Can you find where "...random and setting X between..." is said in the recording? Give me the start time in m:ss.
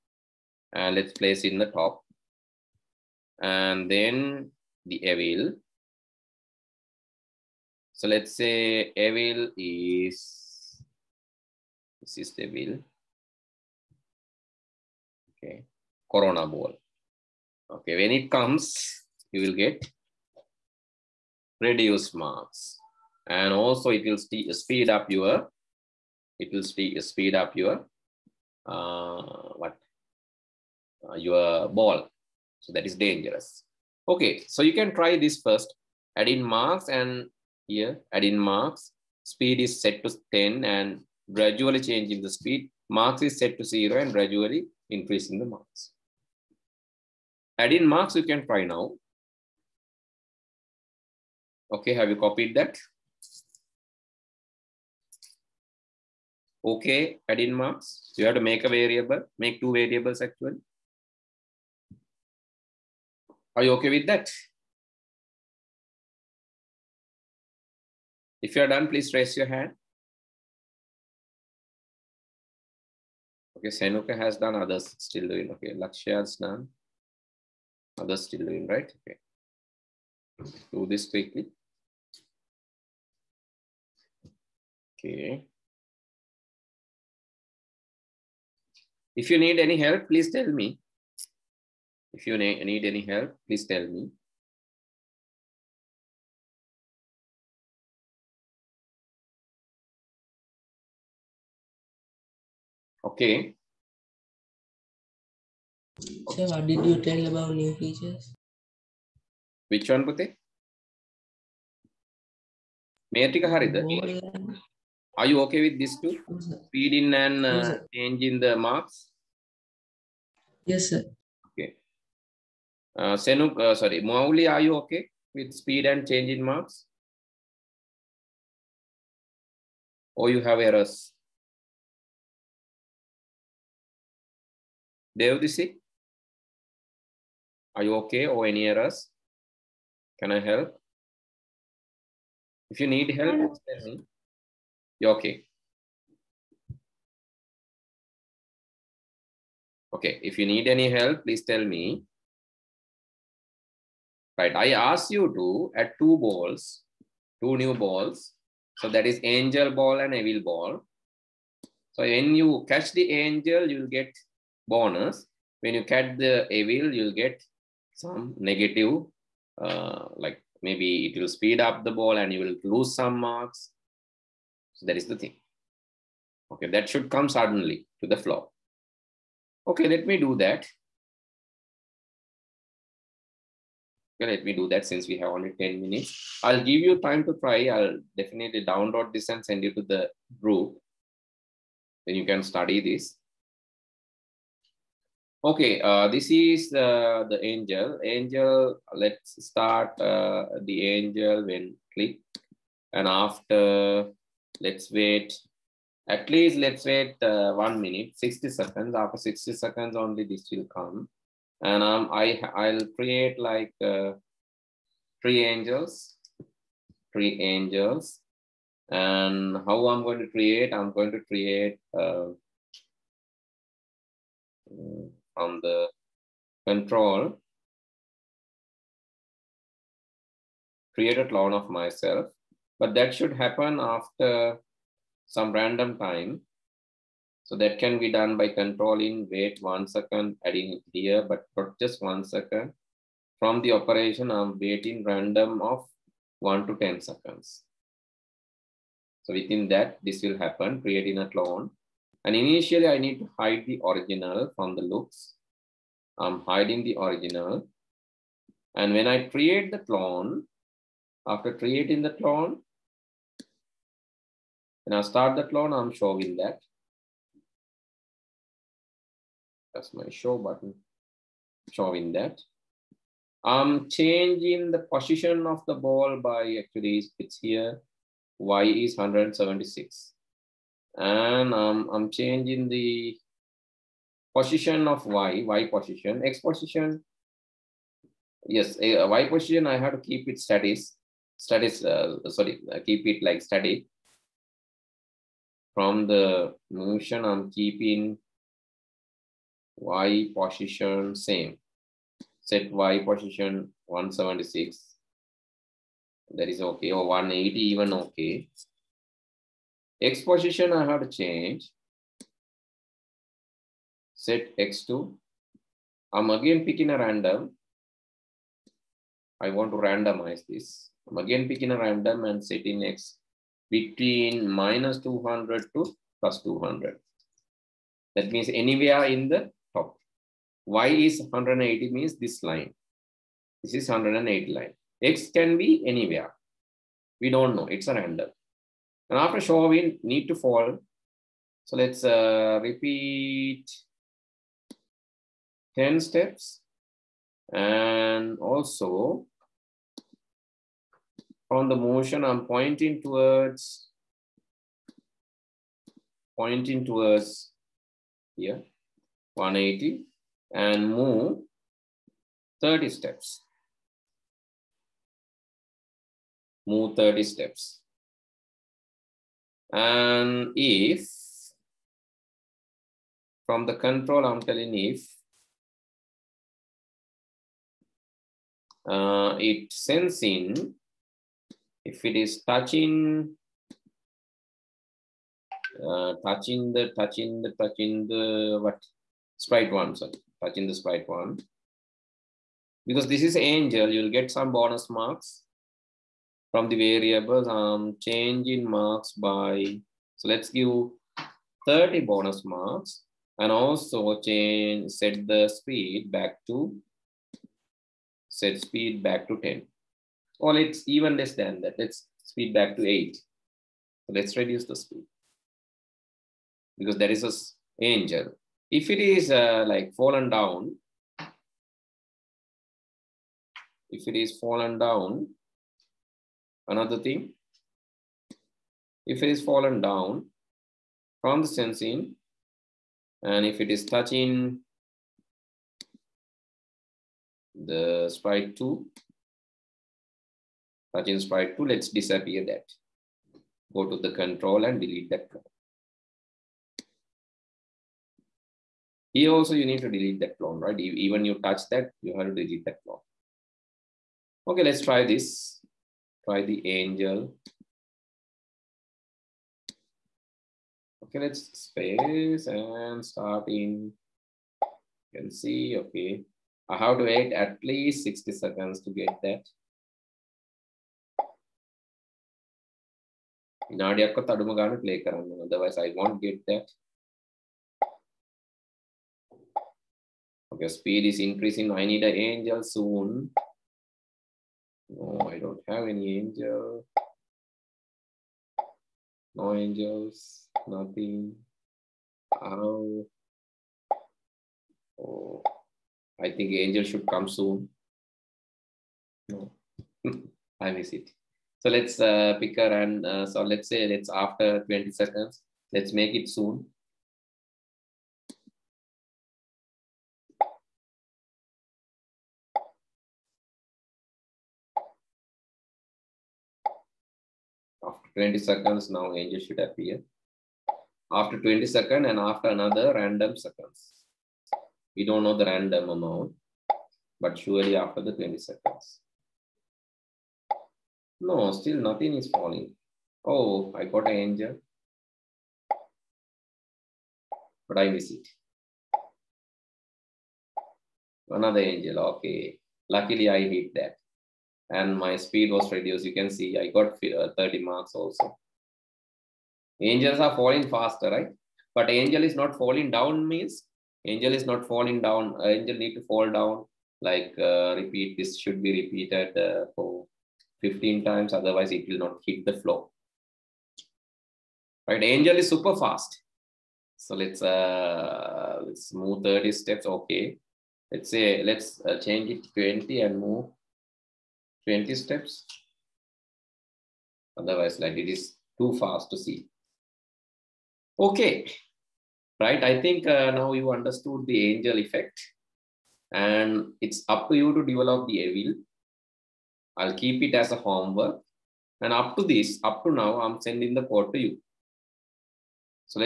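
5:21.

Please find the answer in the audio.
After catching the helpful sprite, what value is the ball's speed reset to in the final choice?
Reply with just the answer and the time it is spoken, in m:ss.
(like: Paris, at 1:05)
8, at 6:52.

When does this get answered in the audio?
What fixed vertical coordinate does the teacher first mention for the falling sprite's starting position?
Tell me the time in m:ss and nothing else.
4:38.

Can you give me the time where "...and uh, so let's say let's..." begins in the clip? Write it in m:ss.
8:22.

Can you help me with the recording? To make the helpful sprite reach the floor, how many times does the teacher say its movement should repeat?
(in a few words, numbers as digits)
15.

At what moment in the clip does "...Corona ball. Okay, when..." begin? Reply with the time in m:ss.
0:16.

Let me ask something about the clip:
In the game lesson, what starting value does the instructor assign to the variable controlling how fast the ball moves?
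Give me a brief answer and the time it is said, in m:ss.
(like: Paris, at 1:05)
10, at 0:39.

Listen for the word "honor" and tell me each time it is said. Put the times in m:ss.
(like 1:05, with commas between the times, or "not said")
not said.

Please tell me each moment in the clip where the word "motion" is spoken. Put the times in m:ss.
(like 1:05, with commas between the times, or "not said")
4:56, 5:51.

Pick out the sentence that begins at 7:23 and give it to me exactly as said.
Go to the control and delete that Here also you need to delete that clone, right?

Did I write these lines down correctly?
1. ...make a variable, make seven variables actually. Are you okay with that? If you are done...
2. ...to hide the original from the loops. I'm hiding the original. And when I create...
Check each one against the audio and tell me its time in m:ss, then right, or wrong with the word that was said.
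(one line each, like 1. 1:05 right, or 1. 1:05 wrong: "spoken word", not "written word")
1. 0:58 wrong: "two", not "seven"
2. 4:13 right.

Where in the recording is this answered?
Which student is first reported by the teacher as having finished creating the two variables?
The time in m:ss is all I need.
1:13.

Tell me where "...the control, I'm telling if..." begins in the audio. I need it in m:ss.
6:13.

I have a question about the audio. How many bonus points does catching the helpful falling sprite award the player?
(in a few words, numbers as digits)
30.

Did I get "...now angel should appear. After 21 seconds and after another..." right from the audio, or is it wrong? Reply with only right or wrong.
wrong.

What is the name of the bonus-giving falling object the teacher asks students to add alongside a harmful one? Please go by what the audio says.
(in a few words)
angel ball.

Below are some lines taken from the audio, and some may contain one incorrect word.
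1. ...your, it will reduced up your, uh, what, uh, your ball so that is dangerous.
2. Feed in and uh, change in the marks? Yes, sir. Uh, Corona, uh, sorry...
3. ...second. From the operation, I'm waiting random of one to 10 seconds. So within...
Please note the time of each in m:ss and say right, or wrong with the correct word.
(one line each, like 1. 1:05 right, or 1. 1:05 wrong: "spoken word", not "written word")
1. 0:25 wrong: "speed", not "reduced"
2. 1:56 wrong: "Senuk", not "Corona"
3. 4:02 right.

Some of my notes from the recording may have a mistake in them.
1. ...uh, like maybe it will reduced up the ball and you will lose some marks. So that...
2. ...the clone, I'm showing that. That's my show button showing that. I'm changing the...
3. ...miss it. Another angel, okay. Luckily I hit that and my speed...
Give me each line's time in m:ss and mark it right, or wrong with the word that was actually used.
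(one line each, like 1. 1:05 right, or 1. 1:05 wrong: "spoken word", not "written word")
1. 2:49 wrong: "speed", not "reduced"
2. 4:25 right
3. 8:57 right.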